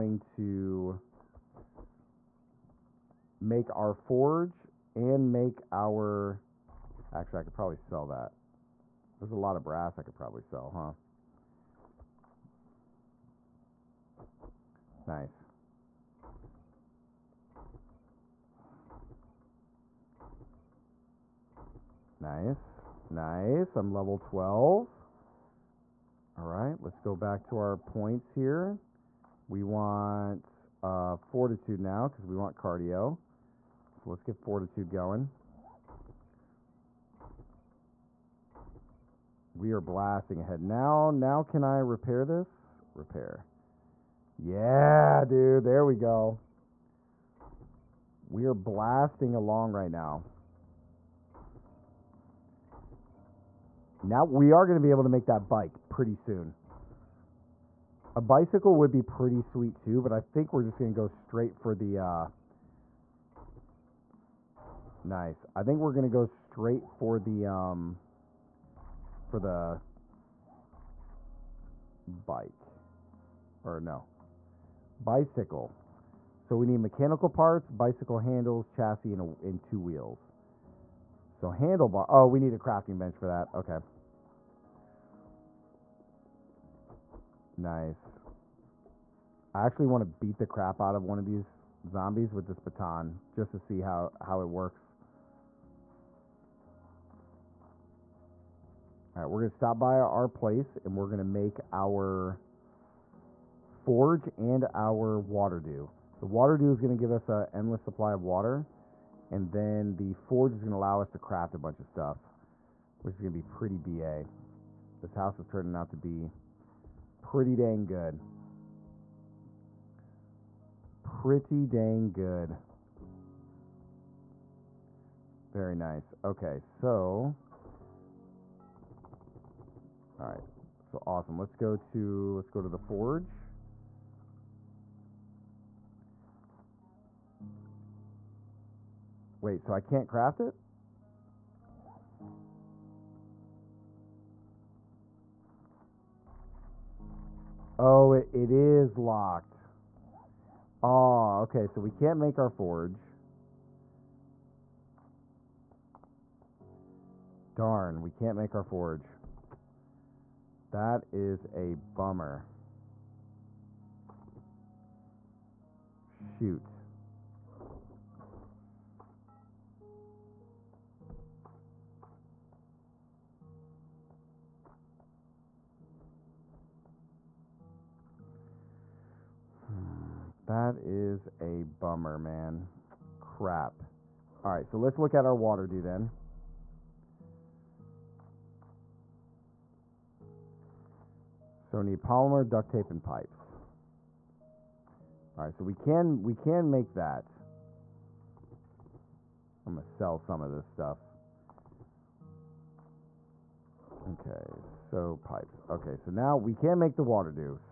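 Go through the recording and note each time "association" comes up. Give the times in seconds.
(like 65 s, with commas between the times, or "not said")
not said.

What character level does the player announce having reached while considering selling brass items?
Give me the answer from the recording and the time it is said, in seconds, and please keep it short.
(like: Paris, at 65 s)
12, at 23 s.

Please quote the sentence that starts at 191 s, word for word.
So need polymer, duct tape, and pipes.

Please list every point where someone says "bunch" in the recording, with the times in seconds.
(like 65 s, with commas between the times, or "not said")
111 s.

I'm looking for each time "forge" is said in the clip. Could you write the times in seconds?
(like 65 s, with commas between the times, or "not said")
3 s, 103 s, 110 s, 132 s, 152 s, 158 s.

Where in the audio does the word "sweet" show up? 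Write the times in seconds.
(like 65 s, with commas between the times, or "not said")
59 s.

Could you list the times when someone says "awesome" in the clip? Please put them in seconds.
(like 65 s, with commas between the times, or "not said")
131 s.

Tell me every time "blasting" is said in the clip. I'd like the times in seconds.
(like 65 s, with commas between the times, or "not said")
39 s, 48 s.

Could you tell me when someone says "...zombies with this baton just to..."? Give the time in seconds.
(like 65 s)
91 s.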